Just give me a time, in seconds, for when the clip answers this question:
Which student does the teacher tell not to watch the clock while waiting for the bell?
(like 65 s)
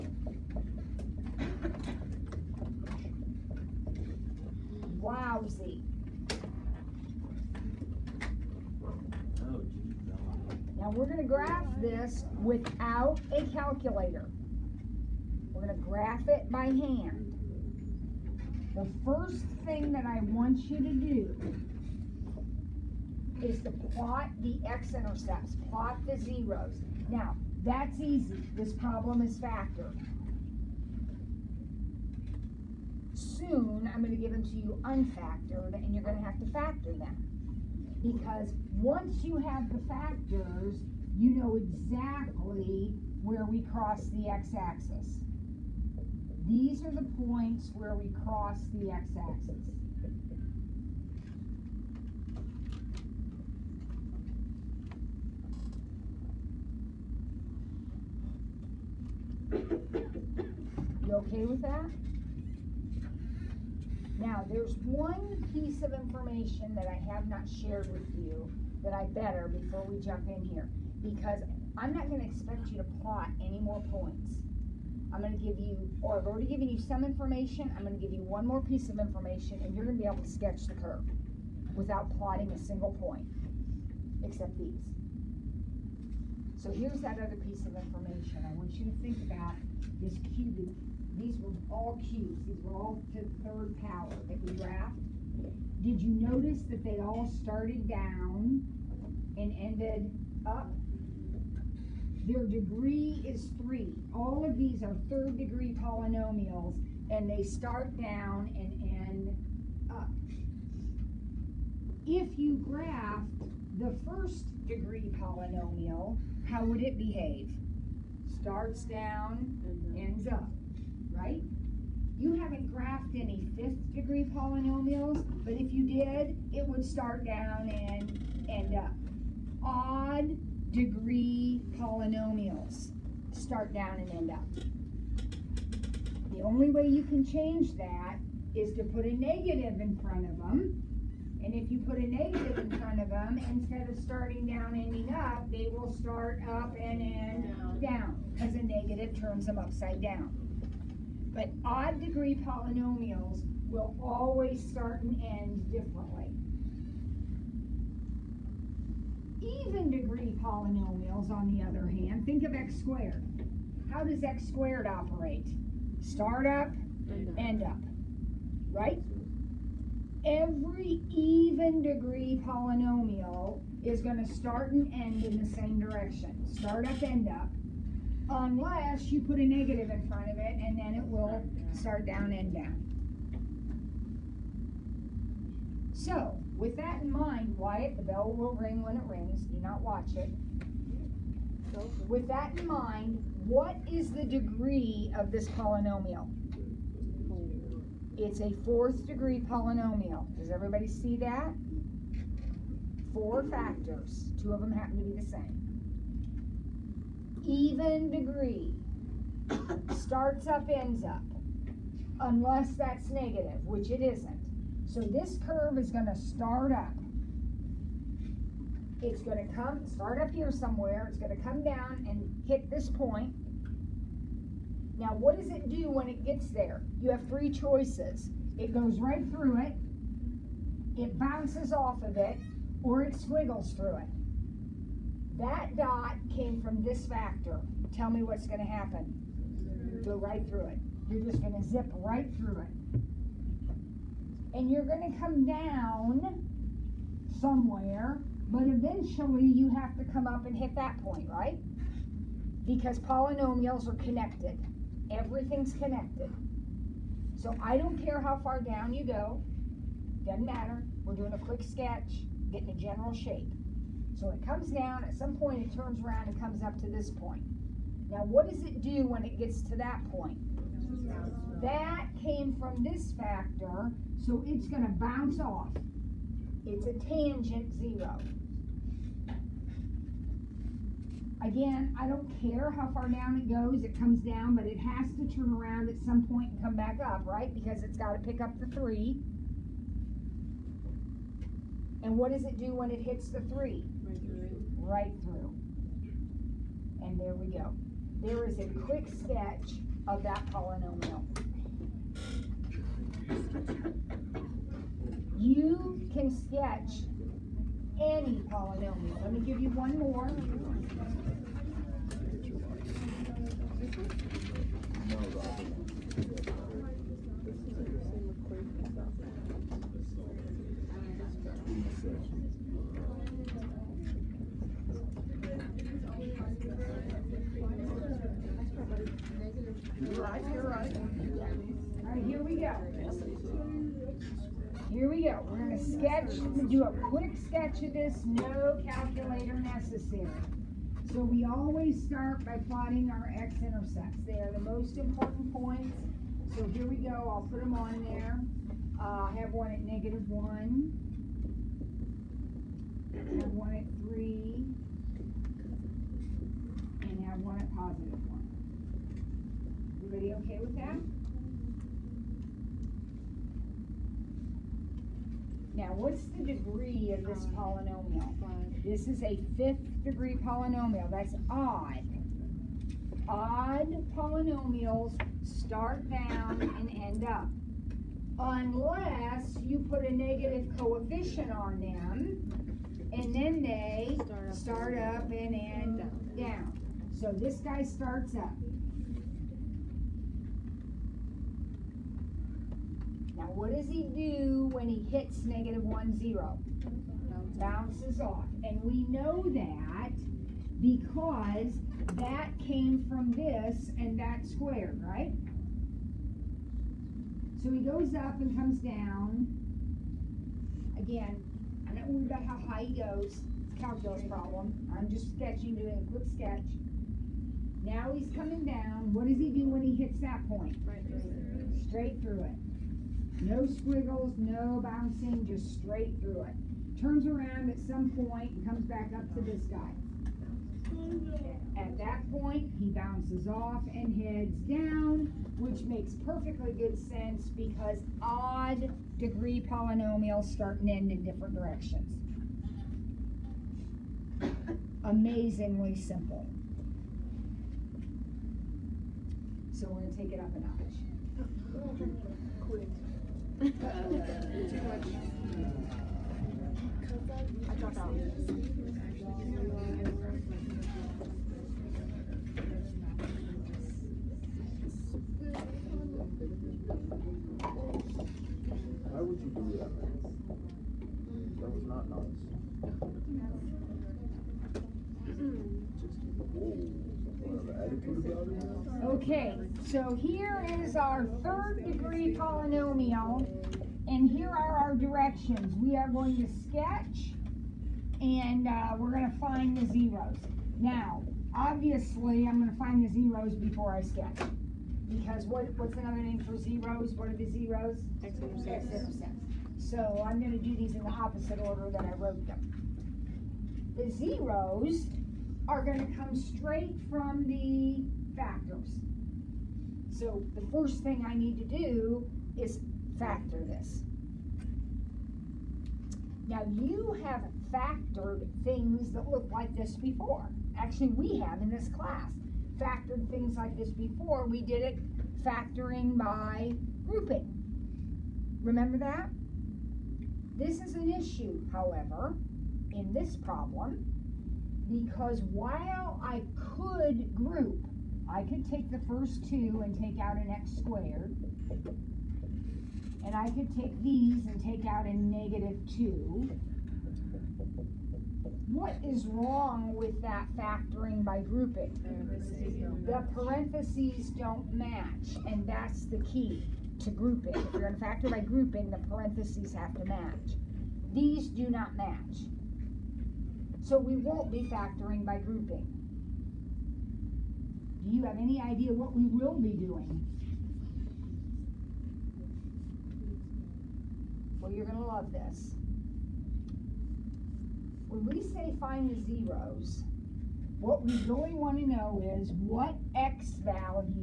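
187 s.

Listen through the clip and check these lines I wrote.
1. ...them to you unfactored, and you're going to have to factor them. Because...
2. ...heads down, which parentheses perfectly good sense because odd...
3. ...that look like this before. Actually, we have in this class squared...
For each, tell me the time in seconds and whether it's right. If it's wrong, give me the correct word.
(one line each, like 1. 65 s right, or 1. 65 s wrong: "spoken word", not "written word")
1. 34 s right
2. 434 s wrong: "makes", not "parentheses"
3. 519 s wrong: "factored", not "squared".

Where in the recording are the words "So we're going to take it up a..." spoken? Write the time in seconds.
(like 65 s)
449 s.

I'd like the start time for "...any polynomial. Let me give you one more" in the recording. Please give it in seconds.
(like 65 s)
308 s.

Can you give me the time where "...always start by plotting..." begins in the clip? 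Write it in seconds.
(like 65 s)
341 s.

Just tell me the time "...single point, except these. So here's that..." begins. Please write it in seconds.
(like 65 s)
82 s.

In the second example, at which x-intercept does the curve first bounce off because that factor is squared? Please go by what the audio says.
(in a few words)
-1.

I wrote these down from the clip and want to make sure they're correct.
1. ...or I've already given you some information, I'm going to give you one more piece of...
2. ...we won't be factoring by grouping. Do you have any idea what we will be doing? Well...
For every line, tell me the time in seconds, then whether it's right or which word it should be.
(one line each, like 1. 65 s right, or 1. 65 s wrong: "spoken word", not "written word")
1. 76 s right
2. 563 s right.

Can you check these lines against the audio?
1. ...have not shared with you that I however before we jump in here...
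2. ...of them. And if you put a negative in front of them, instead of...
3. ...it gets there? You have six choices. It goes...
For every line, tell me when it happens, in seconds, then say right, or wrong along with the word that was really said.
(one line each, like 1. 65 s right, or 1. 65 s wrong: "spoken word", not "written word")
1. 67 s wrong: "better", not "however"
2. 140 s right
3. 226 s wrong: "three", not "six".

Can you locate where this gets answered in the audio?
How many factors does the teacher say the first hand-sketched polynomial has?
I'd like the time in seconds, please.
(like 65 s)
203 s.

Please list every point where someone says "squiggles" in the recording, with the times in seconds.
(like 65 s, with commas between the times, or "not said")
233 s, 423 s.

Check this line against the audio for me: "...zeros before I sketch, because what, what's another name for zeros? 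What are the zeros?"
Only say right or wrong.
right.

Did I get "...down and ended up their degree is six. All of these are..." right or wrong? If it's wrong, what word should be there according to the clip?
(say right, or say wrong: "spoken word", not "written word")
wrong: "three", not "six".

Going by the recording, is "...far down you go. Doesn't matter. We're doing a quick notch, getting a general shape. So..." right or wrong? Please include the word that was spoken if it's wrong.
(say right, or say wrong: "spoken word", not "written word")
wrong: "sketch", not "notch".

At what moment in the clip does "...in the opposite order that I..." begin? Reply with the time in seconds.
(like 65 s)
500 s.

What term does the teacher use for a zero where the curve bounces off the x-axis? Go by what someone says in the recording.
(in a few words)
tangent zero.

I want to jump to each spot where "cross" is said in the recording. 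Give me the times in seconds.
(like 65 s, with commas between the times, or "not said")
43 s, 48 s.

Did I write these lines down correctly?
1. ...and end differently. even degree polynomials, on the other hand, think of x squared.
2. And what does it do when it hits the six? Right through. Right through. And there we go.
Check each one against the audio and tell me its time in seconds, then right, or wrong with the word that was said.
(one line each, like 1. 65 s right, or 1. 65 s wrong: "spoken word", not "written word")
1. 155 s right
2. 292 s wrong: "three", not "six".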